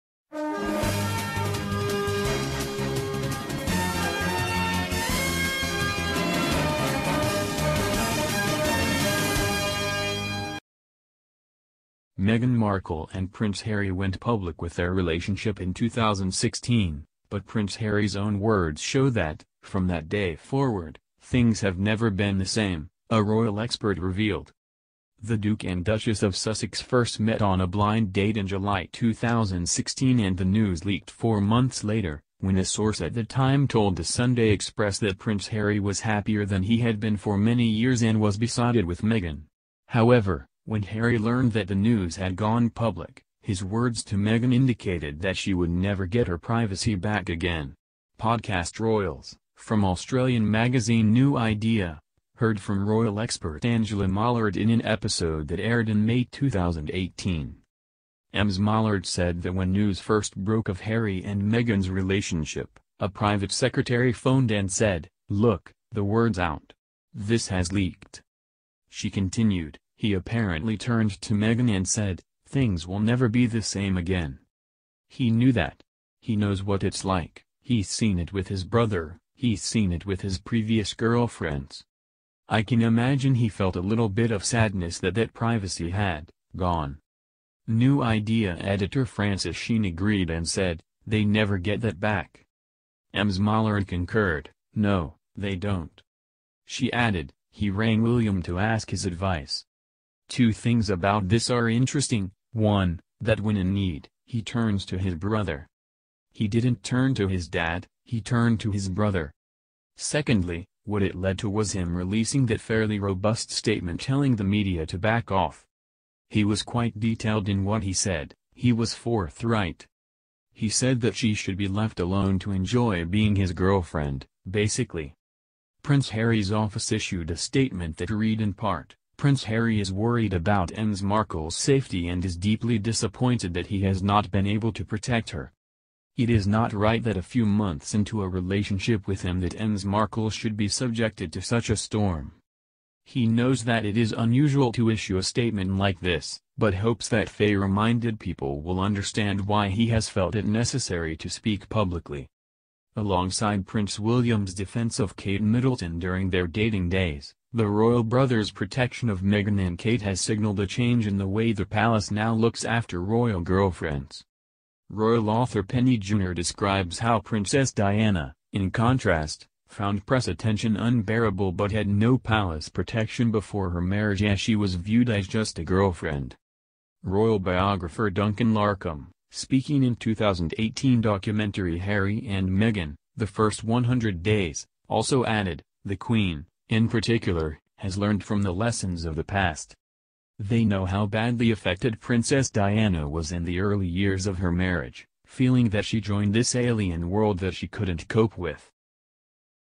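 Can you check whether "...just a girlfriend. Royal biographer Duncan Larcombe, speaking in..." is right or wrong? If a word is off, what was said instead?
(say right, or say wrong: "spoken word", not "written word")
right.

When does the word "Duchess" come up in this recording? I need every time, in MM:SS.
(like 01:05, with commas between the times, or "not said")
00:25.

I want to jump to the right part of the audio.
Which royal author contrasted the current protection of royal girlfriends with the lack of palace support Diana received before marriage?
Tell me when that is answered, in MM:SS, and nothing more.
02:45.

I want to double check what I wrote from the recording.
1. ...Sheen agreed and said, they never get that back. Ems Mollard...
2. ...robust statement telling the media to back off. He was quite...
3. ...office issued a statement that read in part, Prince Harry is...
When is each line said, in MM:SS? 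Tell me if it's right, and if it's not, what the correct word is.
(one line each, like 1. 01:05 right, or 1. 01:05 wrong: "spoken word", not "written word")
1. 01:29 right
2. 01:52 right
3. 02:06 right.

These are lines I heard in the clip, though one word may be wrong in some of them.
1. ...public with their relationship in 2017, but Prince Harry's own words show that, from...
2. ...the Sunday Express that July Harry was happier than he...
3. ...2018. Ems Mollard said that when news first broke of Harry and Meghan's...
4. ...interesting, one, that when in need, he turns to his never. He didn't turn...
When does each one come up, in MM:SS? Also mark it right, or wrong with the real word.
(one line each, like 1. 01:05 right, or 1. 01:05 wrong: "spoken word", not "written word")
1. 00:14 wrong: "2016", not "2017"
2. 00:33 wrong: "Prince", not "July"
3. 00:56 right
4. 01:41 wrong: "brother", not "never".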